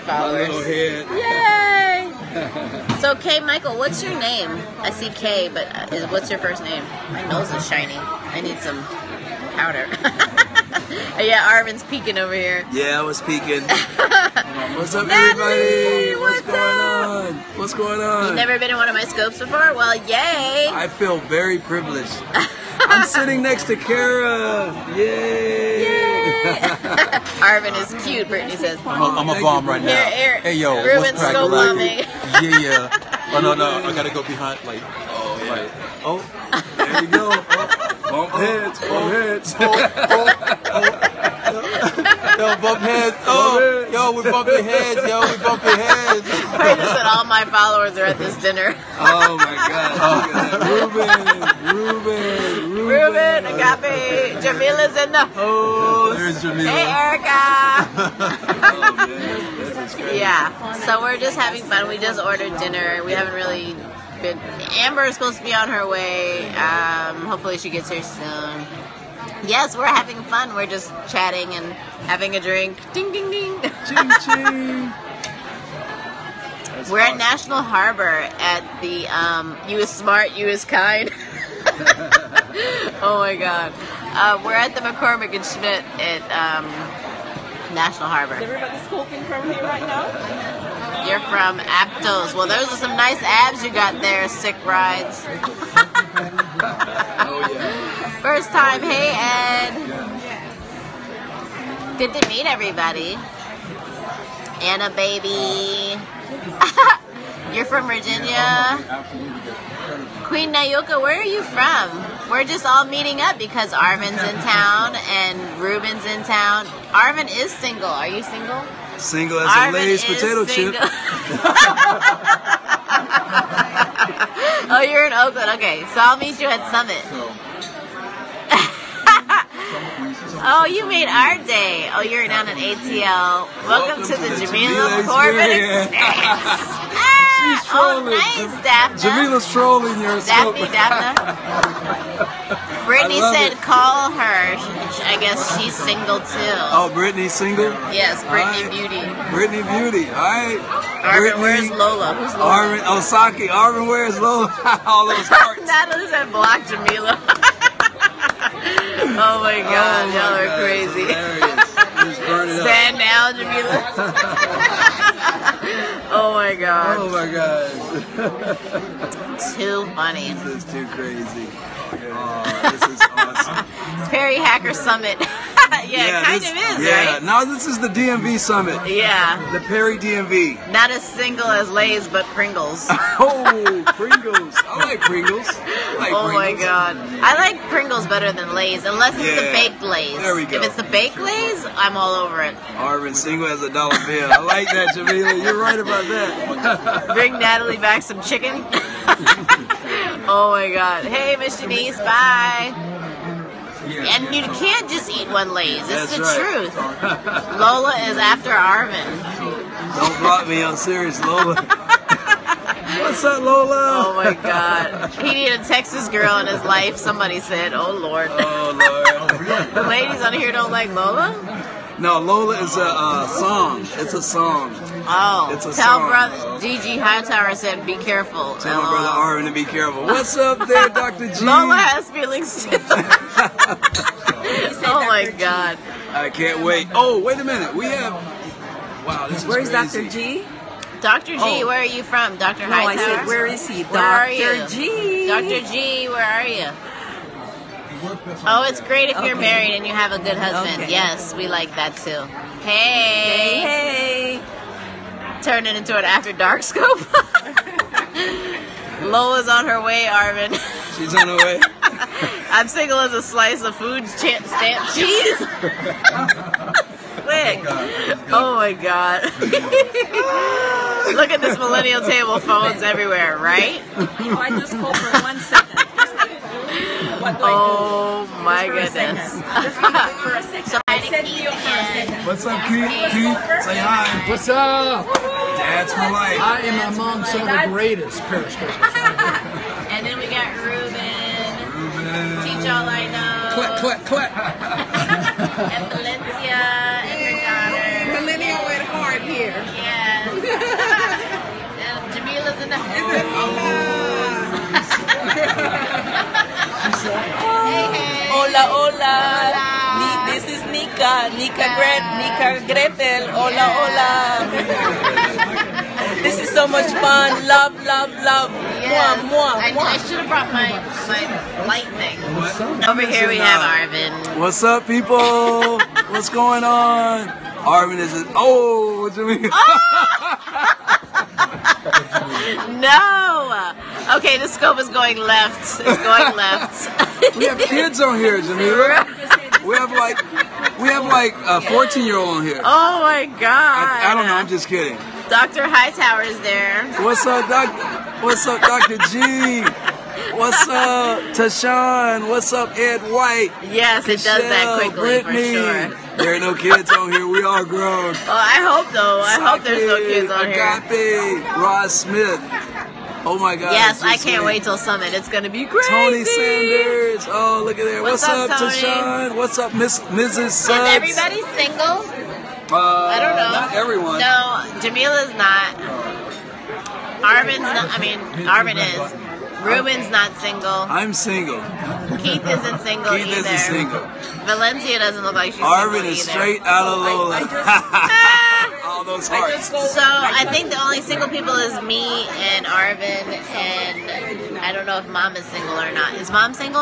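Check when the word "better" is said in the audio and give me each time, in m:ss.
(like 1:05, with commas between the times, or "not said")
3:08.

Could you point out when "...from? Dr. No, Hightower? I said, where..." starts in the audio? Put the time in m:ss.
4:02.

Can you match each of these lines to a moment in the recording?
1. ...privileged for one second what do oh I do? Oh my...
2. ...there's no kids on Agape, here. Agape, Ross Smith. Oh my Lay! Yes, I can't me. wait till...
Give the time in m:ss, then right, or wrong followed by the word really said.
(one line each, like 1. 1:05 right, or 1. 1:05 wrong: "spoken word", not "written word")
1. 4:34 wrong: "called", not "privileged"
2. 5:59 wrong: "God", not "Lay".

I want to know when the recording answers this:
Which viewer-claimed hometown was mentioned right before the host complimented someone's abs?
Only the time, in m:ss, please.
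1:31.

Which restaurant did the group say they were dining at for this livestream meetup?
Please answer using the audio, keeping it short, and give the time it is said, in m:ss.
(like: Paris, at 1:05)
McCormick and Schmick's, at 1:24.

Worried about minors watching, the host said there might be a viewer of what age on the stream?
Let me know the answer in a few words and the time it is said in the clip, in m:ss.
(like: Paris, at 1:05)
14, at 5:41.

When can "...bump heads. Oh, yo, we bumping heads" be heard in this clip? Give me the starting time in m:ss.
0:42.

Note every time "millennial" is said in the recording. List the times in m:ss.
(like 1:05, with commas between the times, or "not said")
4:31, 4:58.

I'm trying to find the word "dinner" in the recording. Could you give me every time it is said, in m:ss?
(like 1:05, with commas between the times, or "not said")
0:48, 1:02.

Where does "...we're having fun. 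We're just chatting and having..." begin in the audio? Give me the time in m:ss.
1:09.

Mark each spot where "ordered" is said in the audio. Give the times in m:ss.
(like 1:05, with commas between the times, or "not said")
1:02.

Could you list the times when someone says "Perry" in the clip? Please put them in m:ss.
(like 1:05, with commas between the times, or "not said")
2:54, 2:59.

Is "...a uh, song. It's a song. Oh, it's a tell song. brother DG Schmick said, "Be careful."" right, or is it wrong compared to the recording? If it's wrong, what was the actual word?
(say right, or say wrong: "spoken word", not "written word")
wrong: "Hightower", not "Schmick".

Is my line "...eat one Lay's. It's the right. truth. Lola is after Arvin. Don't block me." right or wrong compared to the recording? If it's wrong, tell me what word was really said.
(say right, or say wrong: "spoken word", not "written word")
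right.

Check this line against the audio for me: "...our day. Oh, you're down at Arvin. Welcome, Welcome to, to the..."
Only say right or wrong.
wrong.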